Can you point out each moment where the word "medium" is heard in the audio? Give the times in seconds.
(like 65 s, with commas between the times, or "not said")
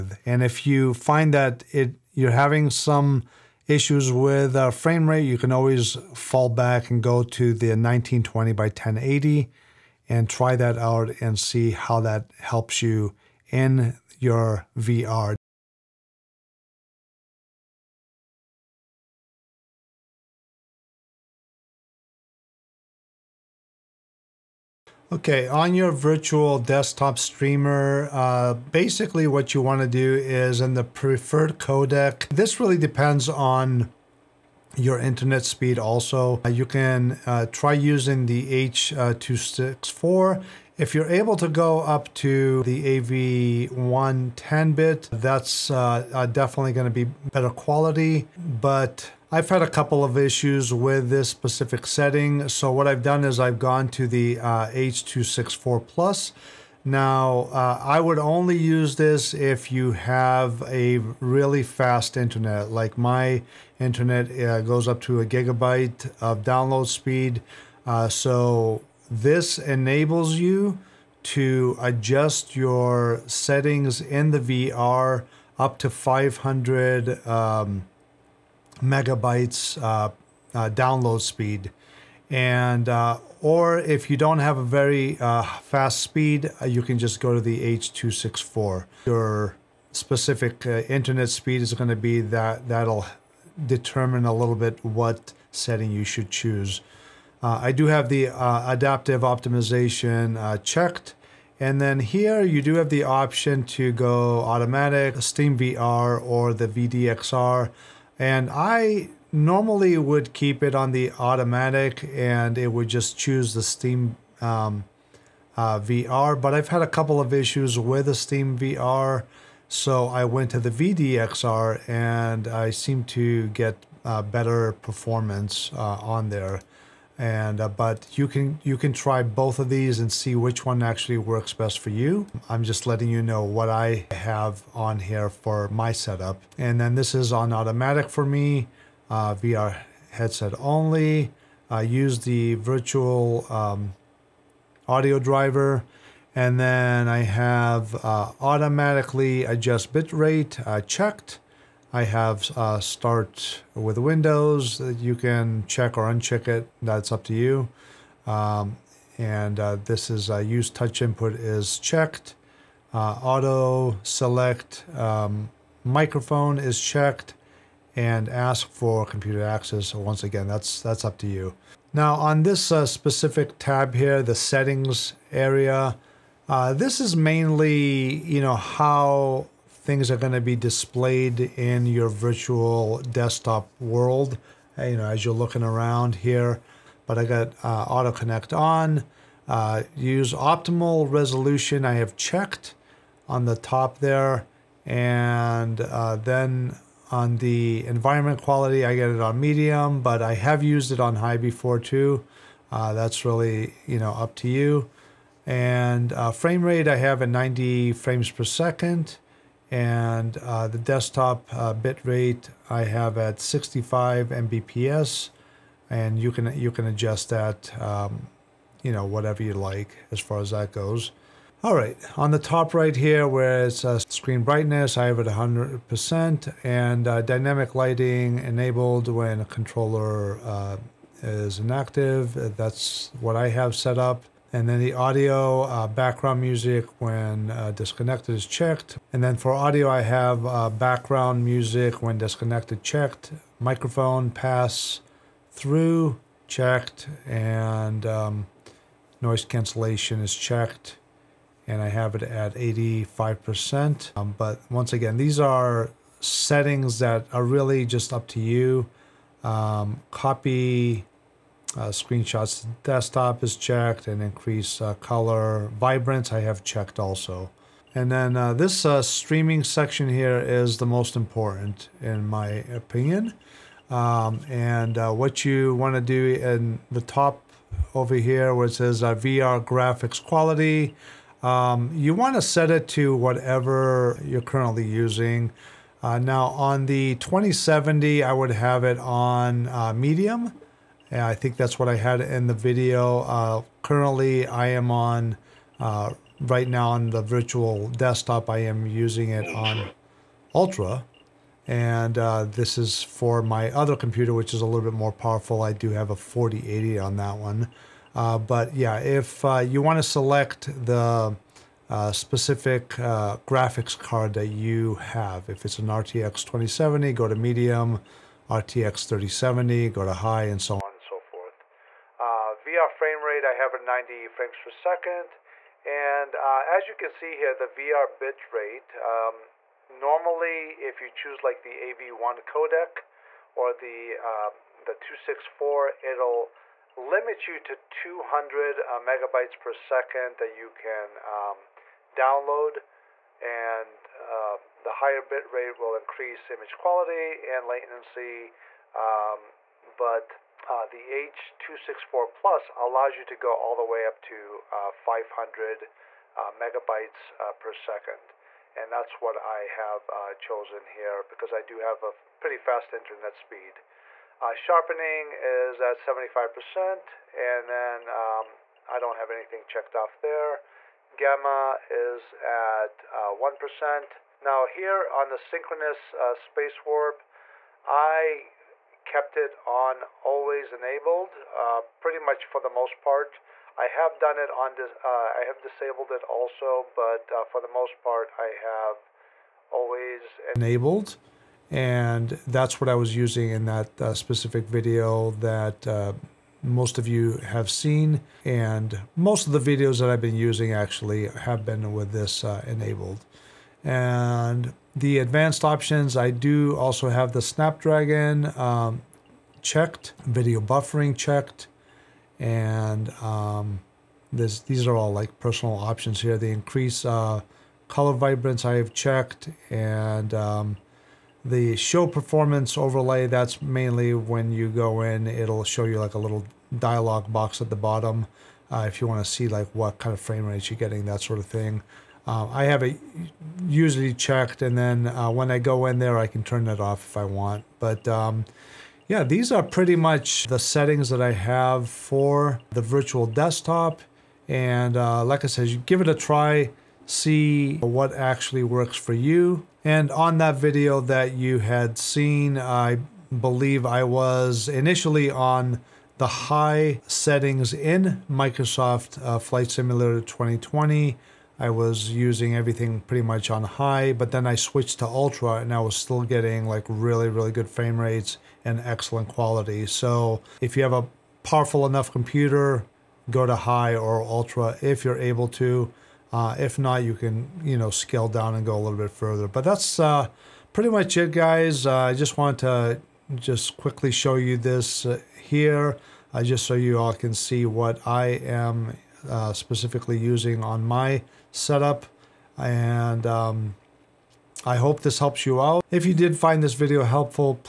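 199 s, 290 s, 317 s.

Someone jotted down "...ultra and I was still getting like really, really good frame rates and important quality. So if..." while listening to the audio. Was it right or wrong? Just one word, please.
wrong.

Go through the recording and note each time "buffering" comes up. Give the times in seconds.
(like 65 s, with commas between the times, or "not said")
410 s.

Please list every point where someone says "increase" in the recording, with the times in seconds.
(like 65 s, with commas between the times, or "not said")
264 s, 345 s, 416 s.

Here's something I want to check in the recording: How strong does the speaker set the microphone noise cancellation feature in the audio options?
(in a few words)
85%.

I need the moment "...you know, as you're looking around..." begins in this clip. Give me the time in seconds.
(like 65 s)
184 s.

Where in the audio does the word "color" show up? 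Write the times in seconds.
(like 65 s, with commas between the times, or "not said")
264 s, 417 s.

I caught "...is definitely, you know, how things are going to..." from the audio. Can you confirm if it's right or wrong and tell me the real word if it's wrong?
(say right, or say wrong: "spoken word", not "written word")
wrong: "mainly", not "definitely".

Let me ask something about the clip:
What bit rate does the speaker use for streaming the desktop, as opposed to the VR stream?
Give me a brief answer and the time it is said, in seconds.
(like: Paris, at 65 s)
65 Mbps, at 213 s.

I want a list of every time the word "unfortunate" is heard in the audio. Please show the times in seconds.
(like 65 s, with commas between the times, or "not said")
not said.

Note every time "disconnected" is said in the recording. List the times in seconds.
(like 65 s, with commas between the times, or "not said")
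237 s, 242 s.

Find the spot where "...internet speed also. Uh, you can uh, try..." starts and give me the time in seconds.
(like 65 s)
34 s.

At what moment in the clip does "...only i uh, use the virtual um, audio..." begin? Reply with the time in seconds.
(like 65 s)
140 s.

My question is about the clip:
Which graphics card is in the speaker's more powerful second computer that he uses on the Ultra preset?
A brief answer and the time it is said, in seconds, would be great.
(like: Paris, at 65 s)
4080, at 306 s.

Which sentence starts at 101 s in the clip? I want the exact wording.
And then here you do have the option to go automatic, Steam VR or the VDXR.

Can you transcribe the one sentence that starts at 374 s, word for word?
Now here on the synchronous uh, space warp, I kept it on always enabled uh, pretty much for the most part.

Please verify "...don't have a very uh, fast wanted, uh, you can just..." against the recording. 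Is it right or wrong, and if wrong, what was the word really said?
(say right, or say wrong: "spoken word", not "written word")
wrong: "speed", not "wanted".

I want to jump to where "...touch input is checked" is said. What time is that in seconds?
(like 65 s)
160 s.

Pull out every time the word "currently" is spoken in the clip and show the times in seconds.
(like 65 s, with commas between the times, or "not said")
284 s, 293 s.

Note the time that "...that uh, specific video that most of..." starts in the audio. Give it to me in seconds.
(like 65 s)
393 s.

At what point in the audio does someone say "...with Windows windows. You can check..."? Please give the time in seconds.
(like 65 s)
153 s.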